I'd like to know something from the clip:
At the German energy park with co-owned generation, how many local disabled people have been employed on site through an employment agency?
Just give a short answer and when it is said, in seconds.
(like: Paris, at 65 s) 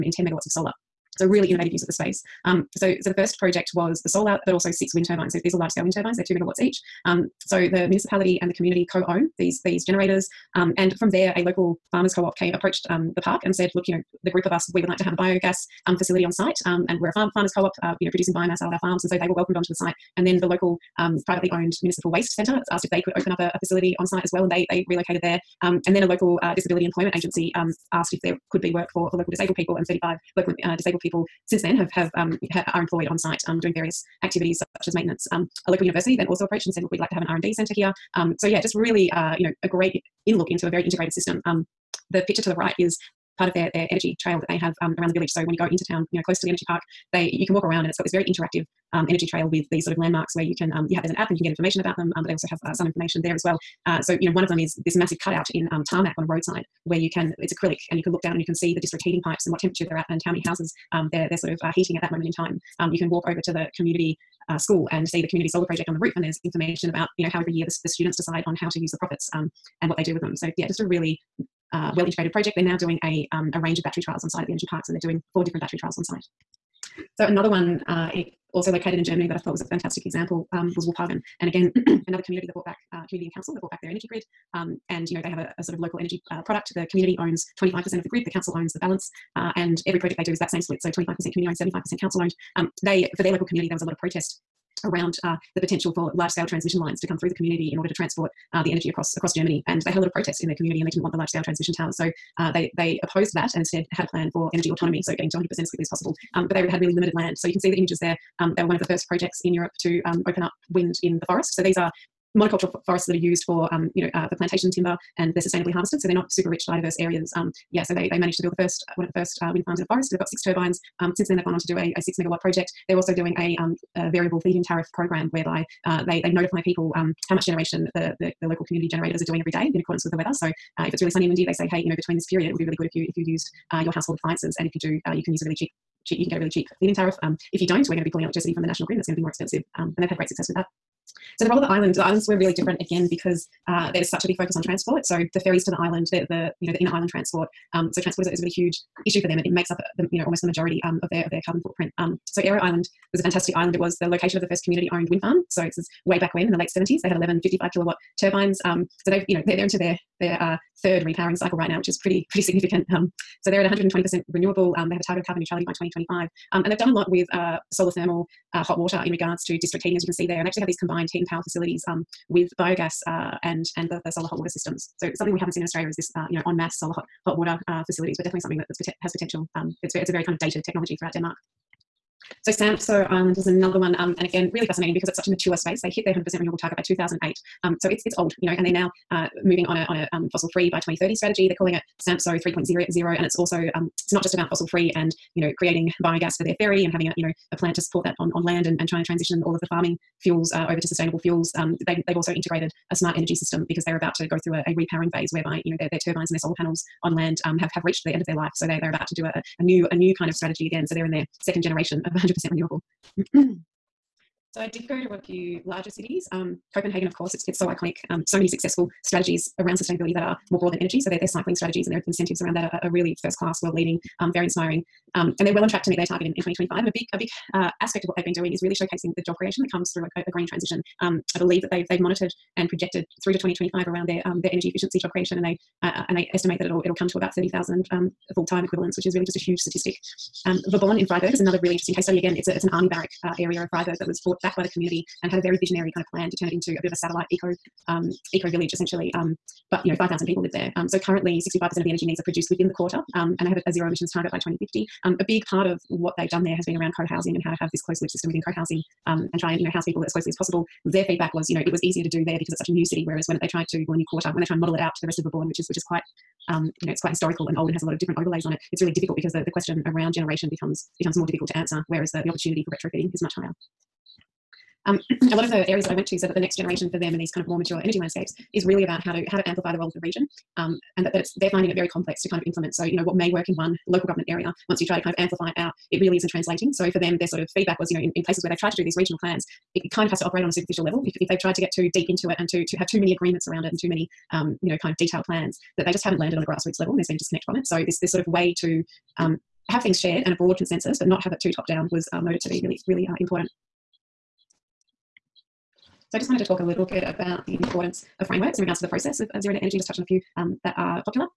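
35, at 29 s.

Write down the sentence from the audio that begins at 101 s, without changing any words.
So uh, they they opposed that and instead had a plan for energy autonomy, so getting to 100% as quickly as possible.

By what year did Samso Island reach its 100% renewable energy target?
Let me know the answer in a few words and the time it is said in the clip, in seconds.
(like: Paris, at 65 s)
2008, at 186 s.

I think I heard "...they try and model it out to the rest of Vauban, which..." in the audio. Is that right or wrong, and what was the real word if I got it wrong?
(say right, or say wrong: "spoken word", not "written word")
right.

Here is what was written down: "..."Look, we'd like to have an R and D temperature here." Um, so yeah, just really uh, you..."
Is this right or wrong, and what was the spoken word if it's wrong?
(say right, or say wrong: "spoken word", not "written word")
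wrong: "centre", not "temperature".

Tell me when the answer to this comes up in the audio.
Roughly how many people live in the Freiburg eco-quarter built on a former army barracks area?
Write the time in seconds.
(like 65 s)
249 s.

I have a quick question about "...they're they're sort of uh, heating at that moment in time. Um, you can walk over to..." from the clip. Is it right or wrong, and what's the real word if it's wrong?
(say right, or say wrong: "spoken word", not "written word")
right.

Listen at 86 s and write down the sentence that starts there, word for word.
The community owns 25% of the grid.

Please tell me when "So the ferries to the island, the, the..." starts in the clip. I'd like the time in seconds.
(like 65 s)
145 s.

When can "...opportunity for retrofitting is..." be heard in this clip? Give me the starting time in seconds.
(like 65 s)
272 s.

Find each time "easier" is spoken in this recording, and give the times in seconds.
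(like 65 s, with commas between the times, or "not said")
261 s.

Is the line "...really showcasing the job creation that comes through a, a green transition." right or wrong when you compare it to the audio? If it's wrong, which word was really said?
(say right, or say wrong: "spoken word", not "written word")
right.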